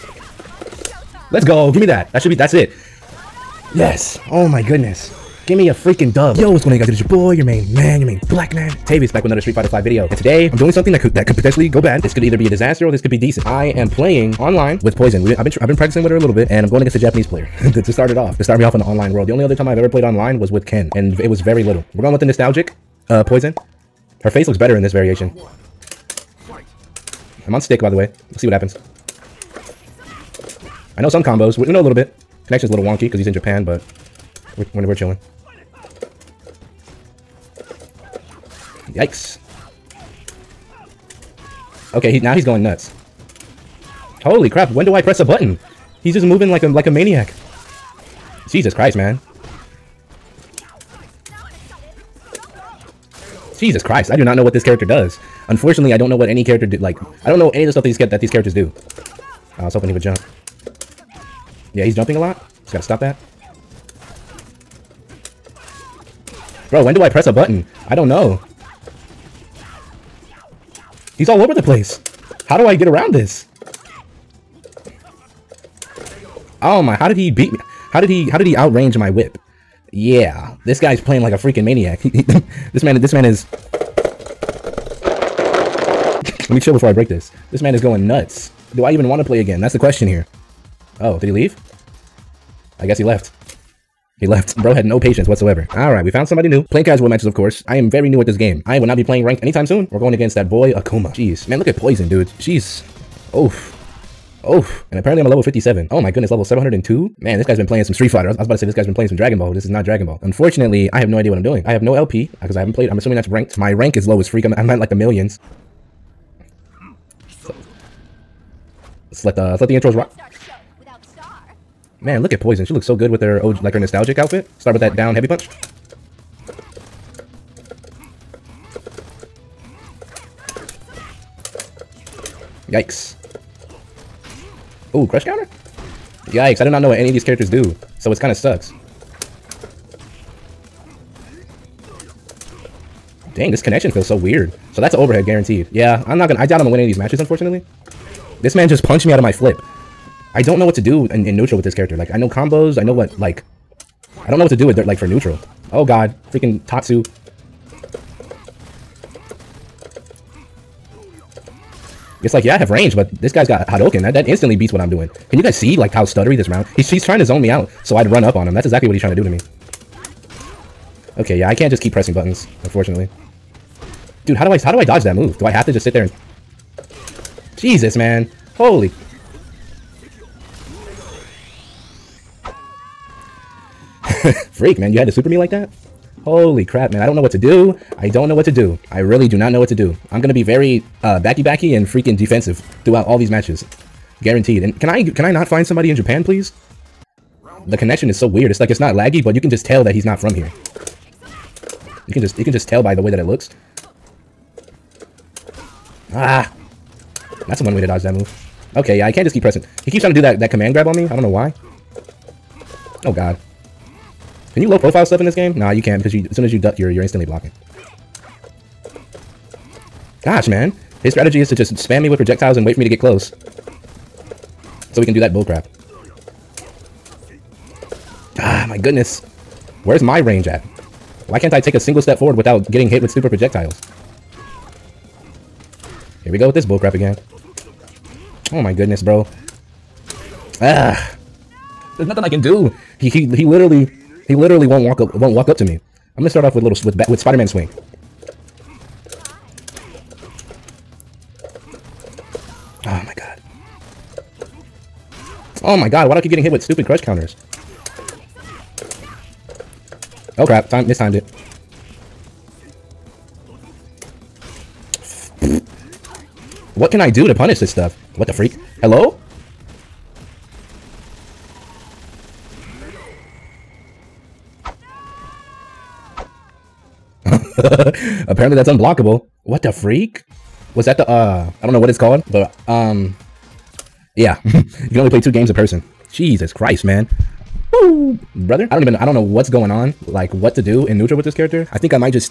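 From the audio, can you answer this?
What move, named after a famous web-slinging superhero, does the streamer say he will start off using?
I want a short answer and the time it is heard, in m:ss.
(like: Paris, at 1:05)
Spider-Man swing, at 4:07.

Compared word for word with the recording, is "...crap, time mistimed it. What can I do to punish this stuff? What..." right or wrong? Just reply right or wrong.
right.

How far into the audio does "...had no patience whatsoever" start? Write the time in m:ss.
1:34.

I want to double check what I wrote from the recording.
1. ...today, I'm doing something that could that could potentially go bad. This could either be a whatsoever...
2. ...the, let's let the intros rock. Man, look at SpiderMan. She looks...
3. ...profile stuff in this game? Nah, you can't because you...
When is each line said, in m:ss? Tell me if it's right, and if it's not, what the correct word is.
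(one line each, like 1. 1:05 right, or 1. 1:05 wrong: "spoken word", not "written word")
1. 0:10 wrong: "disaster", not "whatsoever"
2. 1:59 wrong: "Poison", not "SpiderMan"
3. 3:34 right.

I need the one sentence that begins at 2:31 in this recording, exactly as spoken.
Like, I know combos, I know what, like...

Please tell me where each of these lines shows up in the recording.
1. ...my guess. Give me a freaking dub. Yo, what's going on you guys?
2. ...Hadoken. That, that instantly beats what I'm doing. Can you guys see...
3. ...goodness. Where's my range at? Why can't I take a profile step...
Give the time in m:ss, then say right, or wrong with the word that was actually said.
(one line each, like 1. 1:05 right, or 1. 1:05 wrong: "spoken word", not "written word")
1. 0:04 wrong: "goodness", not "guess"
2. 2:43 right
3. 3:48 wrong: "single", not "profile".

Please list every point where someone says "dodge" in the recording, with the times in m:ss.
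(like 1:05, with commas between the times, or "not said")
2:54, 3:27.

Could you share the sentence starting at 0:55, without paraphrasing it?
Unfortunately, I don't know what any character did like I don't know any of the stuff that these that these characters do.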